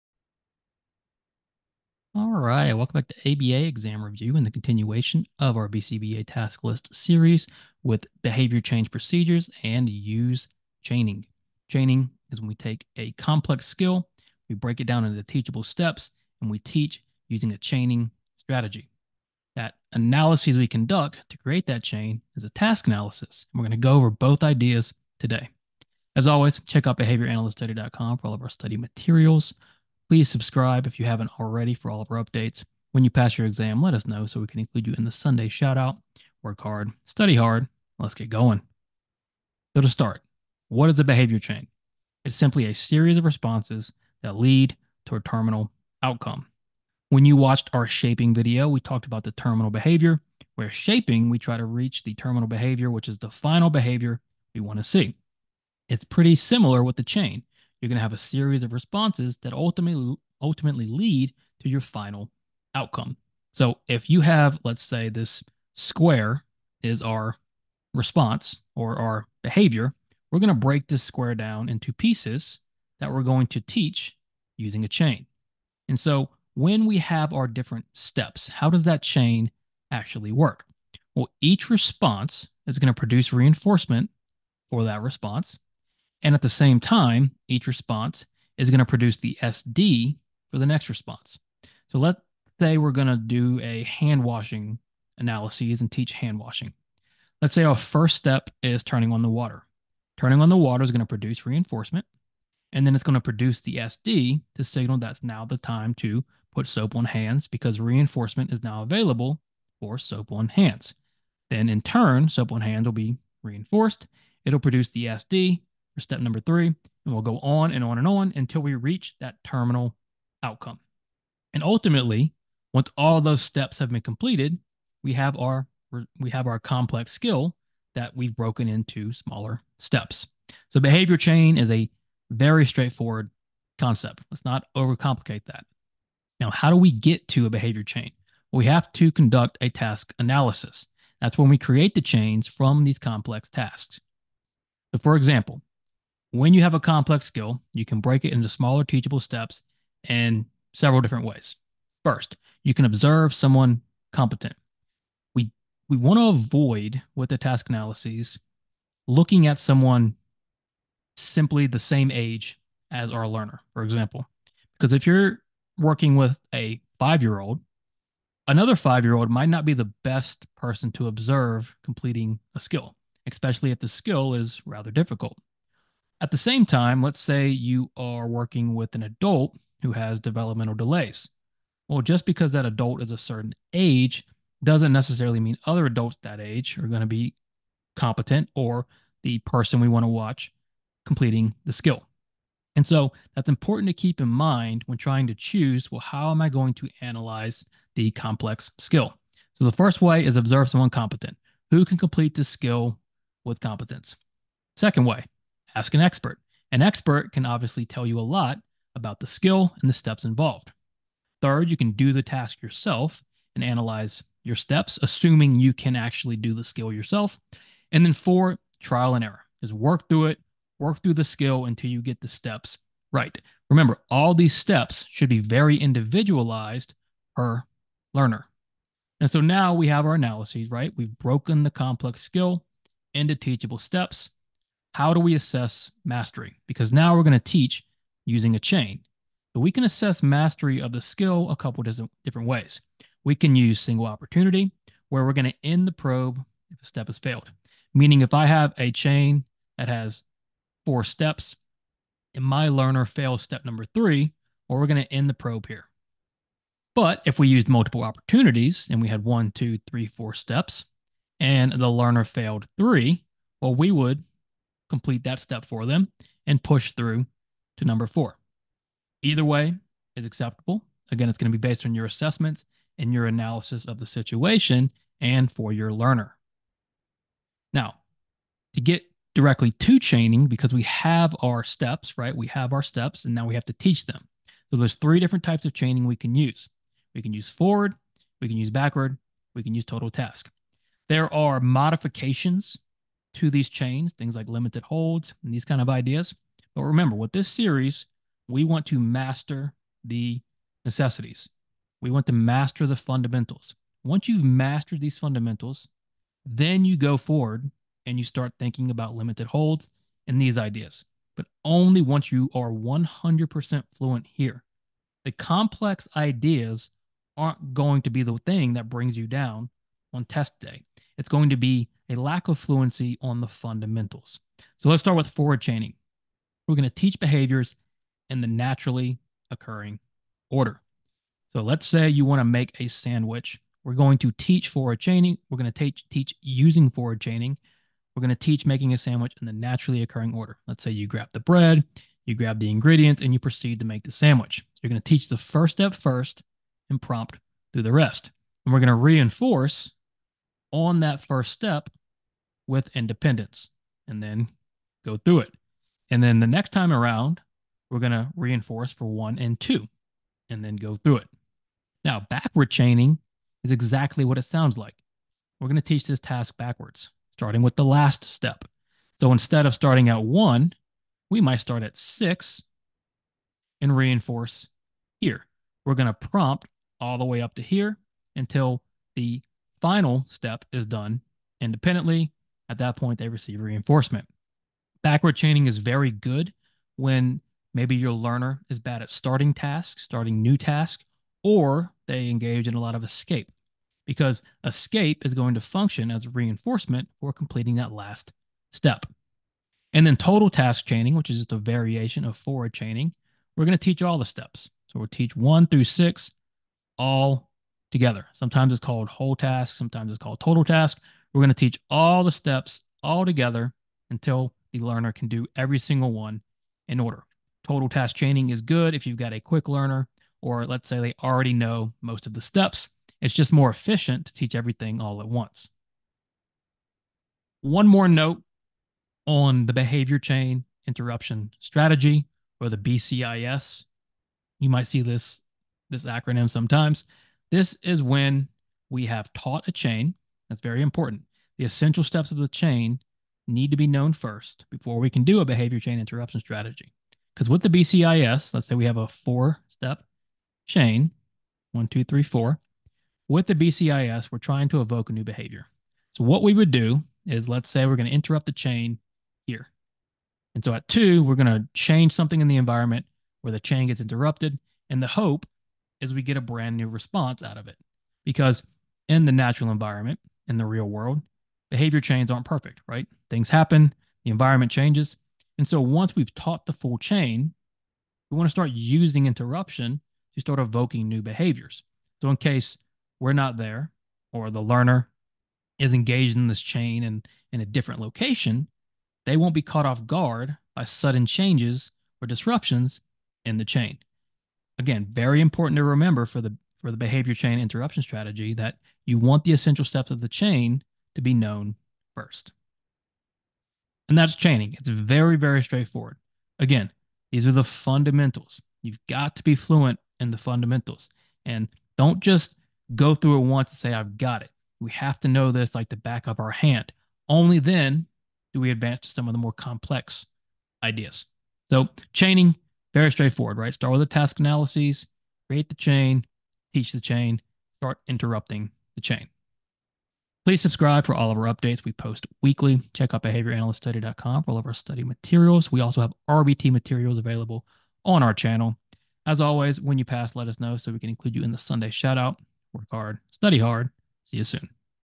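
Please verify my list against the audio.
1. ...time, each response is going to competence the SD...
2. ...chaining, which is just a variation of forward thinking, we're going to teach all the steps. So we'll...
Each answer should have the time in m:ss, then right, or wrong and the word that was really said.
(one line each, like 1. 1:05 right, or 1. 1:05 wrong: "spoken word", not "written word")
1. 1:26 wrong: "produce", not "competence"
2. 6:40 wrong: "chaining", not "thinking".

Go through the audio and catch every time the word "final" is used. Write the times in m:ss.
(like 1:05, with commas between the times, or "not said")
0:53, 1:01, 6:19.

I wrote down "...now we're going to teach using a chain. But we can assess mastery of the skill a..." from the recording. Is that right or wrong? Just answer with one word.
right.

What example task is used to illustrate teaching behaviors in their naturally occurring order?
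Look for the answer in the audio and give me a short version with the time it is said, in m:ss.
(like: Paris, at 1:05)
Making a sandwich, at 5:32.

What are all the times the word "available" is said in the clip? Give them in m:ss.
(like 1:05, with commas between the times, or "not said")
1:48, 8:57.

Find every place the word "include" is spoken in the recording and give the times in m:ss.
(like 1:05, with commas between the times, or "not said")
0:34, 9:01.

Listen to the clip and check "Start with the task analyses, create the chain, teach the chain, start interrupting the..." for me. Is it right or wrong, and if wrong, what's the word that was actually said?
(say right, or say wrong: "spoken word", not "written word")
right.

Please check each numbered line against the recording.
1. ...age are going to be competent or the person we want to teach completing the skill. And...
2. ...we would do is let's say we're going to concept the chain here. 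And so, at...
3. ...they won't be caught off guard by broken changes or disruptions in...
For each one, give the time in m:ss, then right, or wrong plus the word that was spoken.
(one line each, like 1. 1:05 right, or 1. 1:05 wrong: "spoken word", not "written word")
1. 3:06 wrong: "watch", not "teach"
2. 7:36 wrong: "interrupt", not "concept"
3. 8:09 wrong: "sudden", not "broken".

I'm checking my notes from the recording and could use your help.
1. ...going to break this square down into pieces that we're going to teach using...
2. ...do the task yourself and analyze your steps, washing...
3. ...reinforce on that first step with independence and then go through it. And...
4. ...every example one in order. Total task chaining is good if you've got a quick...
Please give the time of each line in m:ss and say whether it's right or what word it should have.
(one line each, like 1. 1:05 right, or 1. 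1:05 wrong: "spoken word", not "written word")
1. 1:10 right
2. 3:31 wrong: "assuming", not "washing"
3. 5:48 right
4. 6:55 wrong: "single", not "example".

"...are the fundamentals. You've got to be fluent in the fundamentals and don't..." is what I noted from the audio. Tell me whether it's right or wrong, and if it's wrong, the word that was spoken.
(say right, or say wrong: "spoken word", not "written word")
right.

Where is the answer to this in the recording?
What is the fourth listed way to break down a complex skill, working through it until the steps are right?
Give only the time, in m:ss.
3:38.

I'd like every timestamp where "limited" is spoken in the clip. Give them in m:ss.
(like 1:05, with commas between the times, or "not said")
4:54, 5:09.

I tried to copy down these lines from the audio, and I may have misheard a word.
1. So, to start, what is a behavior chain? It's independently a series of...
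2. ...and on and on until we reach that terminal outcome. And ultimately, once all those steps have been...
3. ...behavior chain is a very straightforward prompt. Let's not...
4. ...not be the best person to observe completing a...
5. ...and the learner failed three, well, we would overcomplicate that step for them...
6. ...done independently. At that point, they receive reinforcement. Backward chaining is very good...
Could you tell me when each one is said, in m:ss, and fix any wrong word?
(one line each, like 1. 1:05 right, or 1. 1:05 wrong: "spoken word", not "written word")
1. 0:39 wrong: "simply", not "independently"
2. 1:57 right
3. 2:10 wrong: "concept", not "prompt"
4. 2:49 right
5. 4:21 wrong: "complete", not "overcomplicate"
6. 6:20 right.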